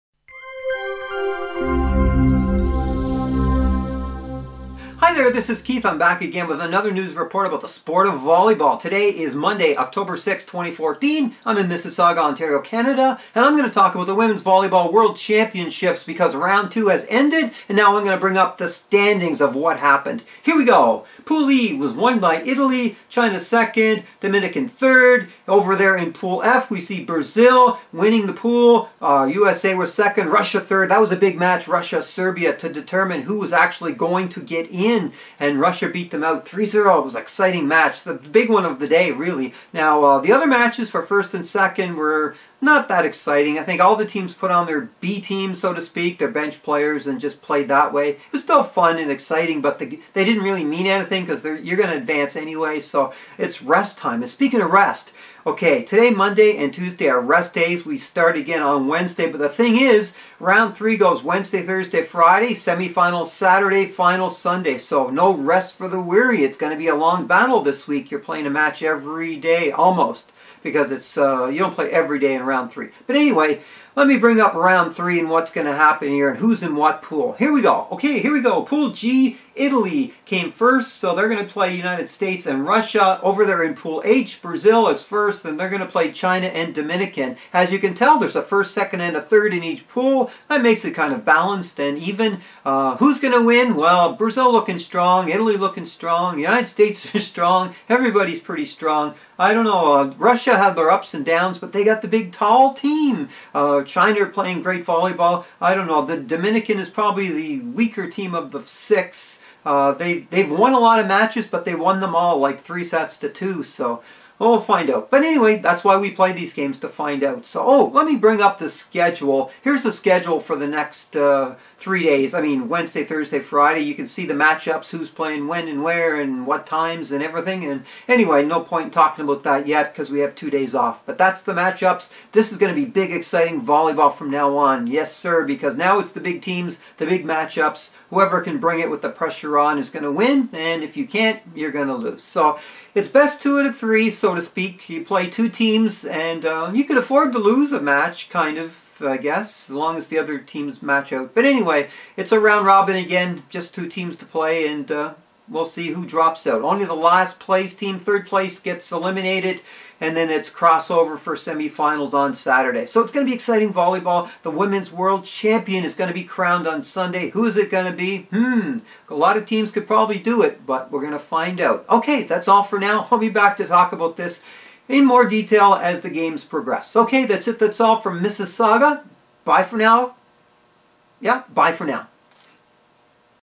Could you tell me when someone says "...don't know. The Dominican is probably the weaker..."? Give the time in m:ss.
1:45.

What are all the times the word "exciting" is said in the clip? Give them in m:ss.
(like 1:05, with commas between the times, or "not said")
0:37, 0:43, 0:49, 2:13, 2:43.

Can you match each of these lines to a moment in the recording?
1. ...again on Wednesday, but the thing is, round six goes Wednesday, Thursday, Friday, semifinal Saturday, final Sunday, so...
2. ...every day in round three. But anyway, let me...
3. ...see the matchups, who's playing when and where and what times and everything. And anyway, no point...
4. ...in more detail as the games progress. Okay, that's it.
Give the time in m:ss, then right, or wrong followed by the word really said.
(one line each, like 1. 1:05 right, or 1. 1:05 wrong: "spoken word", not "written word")
1. 0:58 wrong: "three", not "six"
2. 1:11 right
3. 2:04 right
4. 2:54 right.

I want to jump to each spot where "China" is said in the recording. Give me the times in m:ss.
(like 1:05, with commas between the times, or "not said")
0:23, 1:26, 1:43.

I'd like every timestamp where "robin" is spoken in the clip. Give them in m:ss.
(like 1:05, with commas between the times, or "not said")
2:32.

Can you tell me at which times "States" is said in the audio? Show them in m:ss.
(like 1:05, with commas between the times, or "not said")
1:22, 1:36.